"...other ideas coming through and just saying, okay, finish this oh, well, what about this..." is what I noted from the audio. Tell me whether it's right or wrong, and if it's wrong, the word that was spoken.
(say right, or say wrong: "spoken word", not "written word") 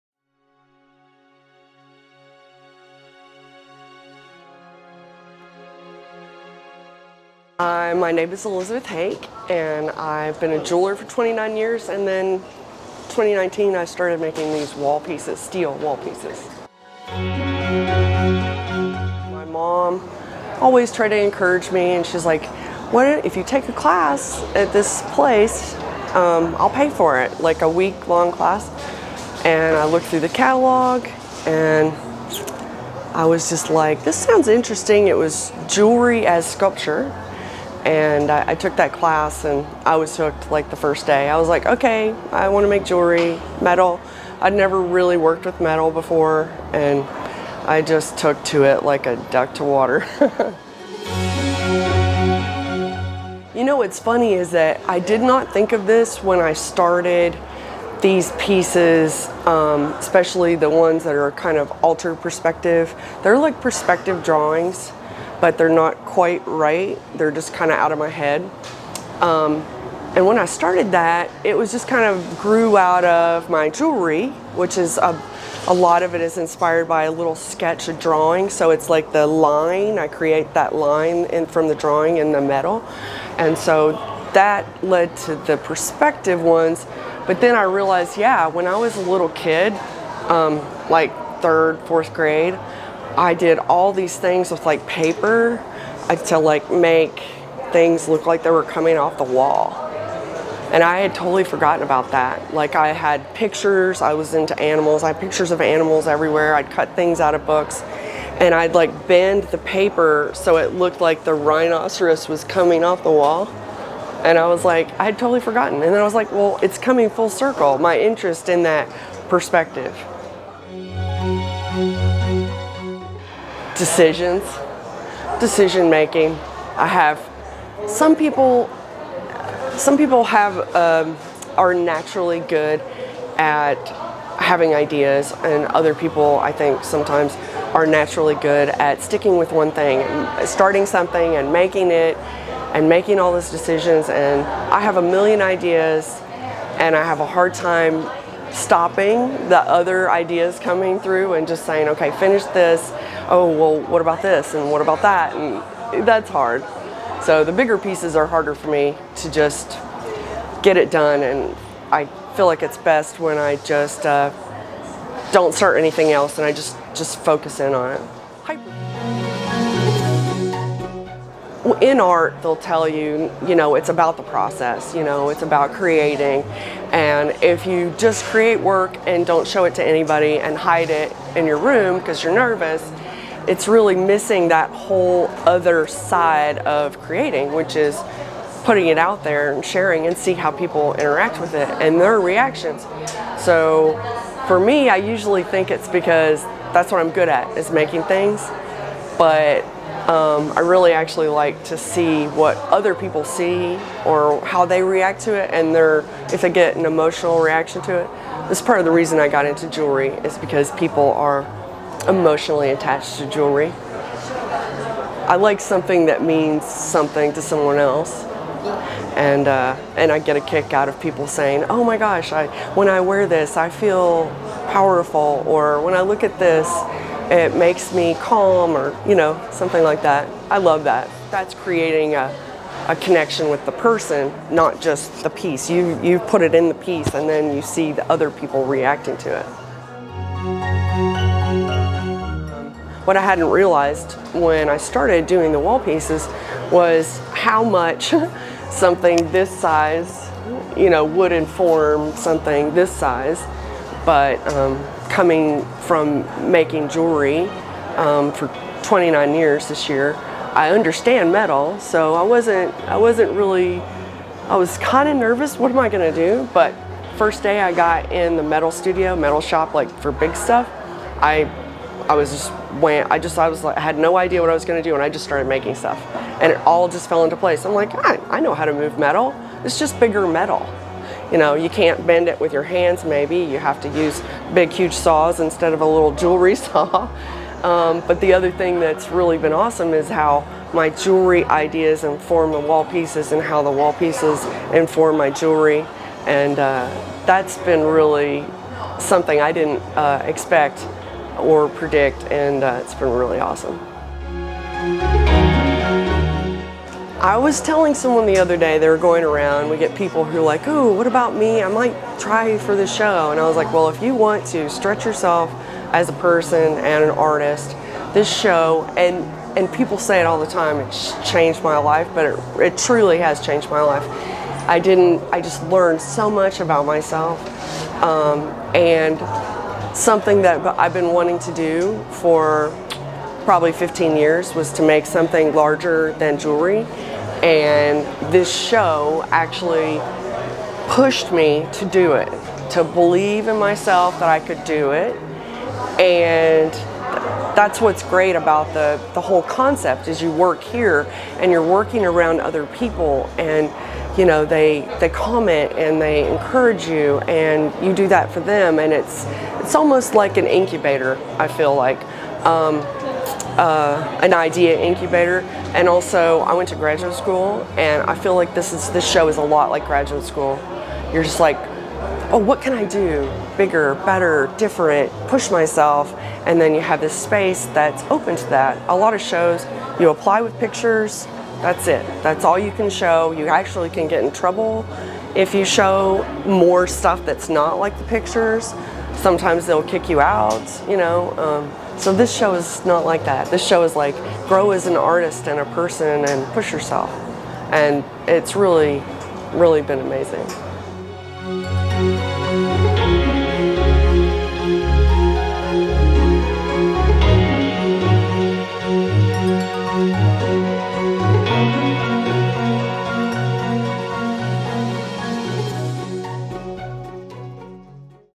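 right.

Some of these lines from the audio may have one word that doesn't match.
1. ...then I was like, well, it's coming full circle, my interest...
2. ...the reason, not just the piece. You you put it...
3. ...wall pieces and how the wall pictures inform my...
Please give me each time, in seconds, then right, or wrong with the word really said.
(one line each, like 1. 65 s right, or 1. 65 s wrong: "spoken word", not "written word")
1. 115 s right
2. 233 s wrong: "person", not "reason"
3. 292 s wrong: "pieces", not "pictures".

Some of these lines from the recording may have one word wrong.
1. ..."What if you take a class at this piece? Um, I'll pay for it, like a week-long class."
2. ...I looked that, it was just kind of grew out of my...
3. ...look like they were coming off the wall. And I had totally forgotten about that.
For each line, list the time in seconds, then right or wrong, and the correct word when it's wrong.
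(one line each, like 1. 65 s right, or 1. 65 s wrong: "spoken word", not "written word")
1. 22 s wrong: "place", not "piece"
2. 70 s wrong: "started", not "looked"
3. 98 s right.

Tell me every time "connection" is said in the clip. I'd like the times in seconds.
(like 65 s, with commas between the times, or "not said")
232 s.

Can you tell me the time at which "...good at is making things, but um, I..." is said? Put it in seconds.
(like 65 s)
197 s.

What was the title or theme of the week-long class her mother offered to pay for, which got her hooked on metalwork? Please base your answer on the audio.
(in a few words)
jewelry as sculpture.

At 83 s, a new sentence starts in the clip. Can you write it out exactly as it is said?
And so that led to the perspective ones.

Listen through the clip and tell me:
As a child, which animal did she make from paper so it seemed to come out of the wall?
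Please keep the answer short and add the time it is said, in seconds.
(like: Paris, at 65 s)
rhinoceros, at 111 s.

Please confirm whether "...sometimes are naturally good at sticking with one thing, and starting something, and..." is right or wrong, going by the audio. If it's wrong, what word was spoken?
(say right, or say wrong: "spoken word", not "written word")
right.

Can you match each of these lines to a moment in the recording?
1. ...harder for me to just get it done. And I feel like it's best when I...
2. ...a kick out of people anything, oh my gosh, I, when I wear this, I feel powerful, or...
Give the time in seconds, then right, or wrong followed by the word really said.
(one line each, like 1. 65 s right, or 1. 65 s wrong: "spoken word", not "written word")
1. 158 s right
2. 220 s wrong: "saying", not "anything".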